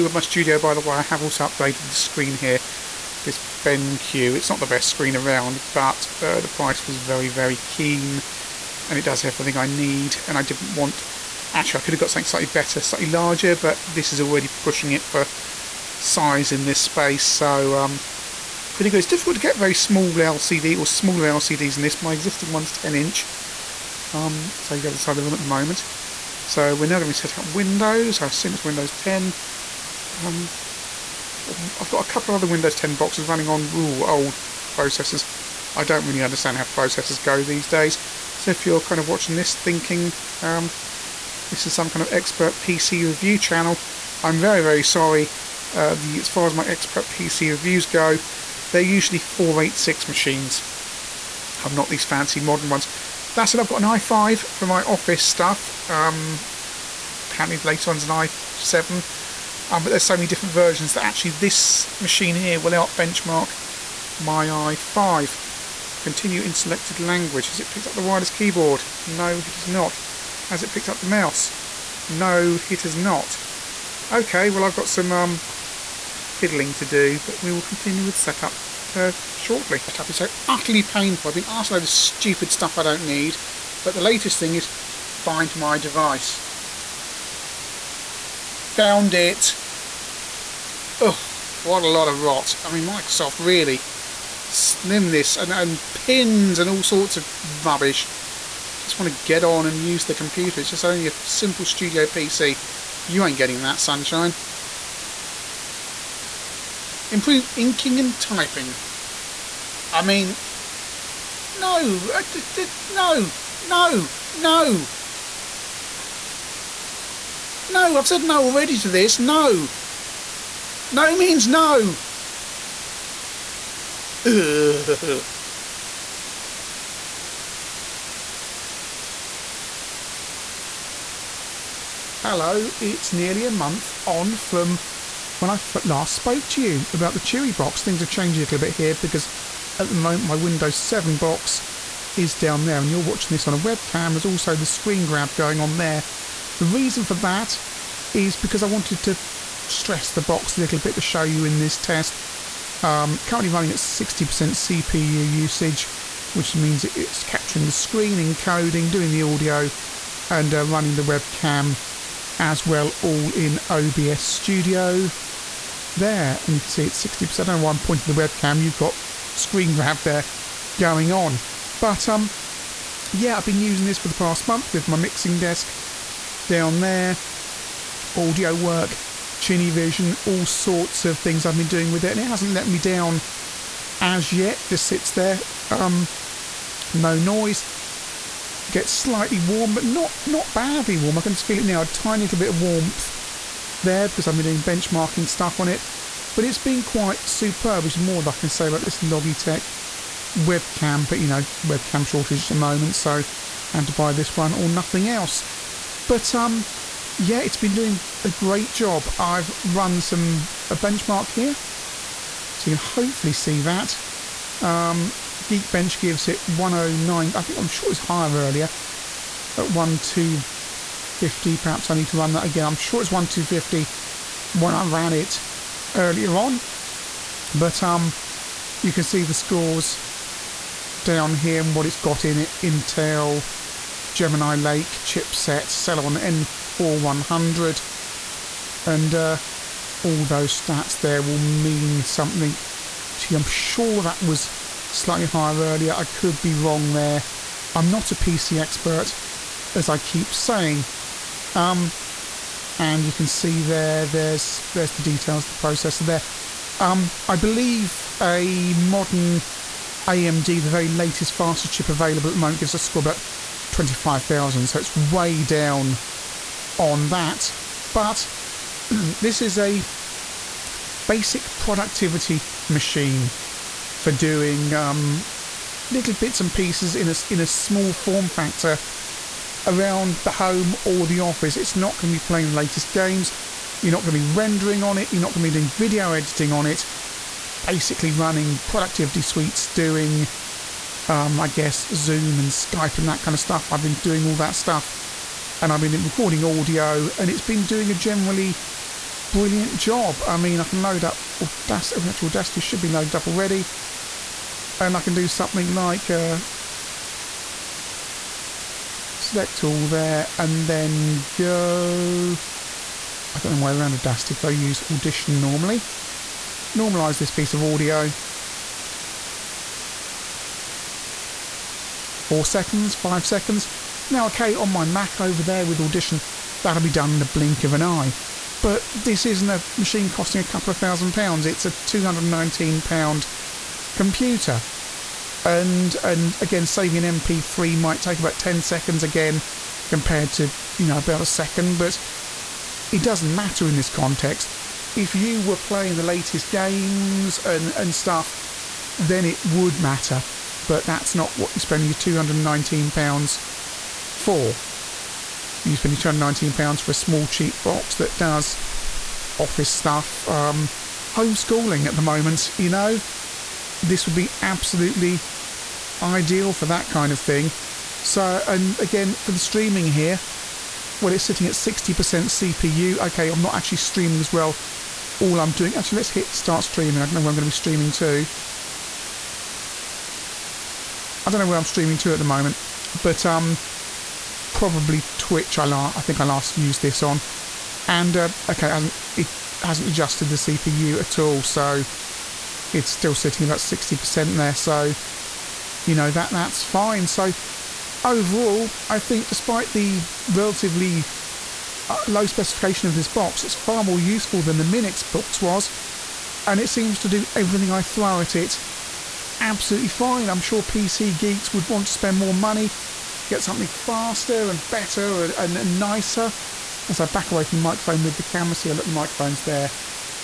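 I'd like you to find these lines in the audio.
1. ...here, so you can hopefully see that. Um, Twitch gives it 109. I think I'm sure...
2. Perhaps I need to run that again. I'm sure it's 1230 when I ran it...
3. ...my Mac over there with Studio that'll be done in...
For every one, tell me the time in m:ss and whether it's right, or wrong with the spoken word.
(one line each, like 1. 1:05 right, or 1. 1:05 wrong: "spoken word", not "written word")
1. 3:31 wrong: "Geekbench", not "Twitch"
2. 3:41 wrong: "1250", not "1230"
3. 5:24 wrong: "Audition", not "Studio".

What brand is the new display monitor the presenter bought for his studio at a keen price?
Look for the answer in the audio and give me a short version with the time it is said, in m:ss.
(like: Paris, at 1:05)
BenQ, at 0:03.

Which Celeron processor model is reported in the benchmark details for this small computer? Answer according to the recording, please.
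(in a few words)
Celeron N4100.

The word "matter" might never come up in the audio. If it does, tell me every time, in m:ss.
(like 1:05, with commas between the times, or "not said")
5:43, 5:49.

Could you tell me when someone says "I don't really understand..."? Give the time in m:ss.
0:35.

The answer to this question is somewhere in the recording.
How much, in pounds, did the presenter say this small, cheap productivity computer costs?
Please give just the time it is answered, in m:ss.
5:31.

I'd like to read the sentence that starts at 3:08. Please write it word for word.
Gets slightly warm, but not not badly warm.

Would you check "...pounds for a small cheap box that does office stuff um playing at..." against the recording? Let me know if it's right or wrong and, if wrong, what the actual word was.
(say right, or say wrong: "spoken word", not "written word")
wrong: "homeschooling", not "playing".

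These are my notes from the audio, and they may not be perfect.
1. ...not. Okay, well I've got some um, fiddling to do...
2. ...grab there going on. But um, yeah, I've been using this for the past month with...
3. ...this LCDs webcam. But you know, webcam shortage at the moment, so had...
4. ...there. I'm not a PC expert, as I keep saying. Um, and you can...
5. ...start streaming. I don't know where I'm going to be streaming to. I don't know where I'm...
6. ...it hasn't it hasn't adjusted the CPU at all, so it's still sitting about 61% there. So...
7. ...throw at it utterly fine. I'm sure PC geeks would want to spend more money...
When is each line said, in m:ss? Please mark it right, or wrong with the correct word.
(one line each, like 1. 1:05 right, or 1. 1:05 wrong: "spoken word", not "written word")
1. 1:12 right
2. 2:49 right
3. 3:18 wrong: "Logitech", not "LCDs"
4. 4:06 right
5. 6:16 right
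6. 6:28 wrong: "60", not "61"
7. 6:47 wrong: "absolutely", not "utterly".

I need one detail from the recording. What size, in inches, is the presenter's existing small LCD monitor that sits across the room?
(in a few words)
10 inch.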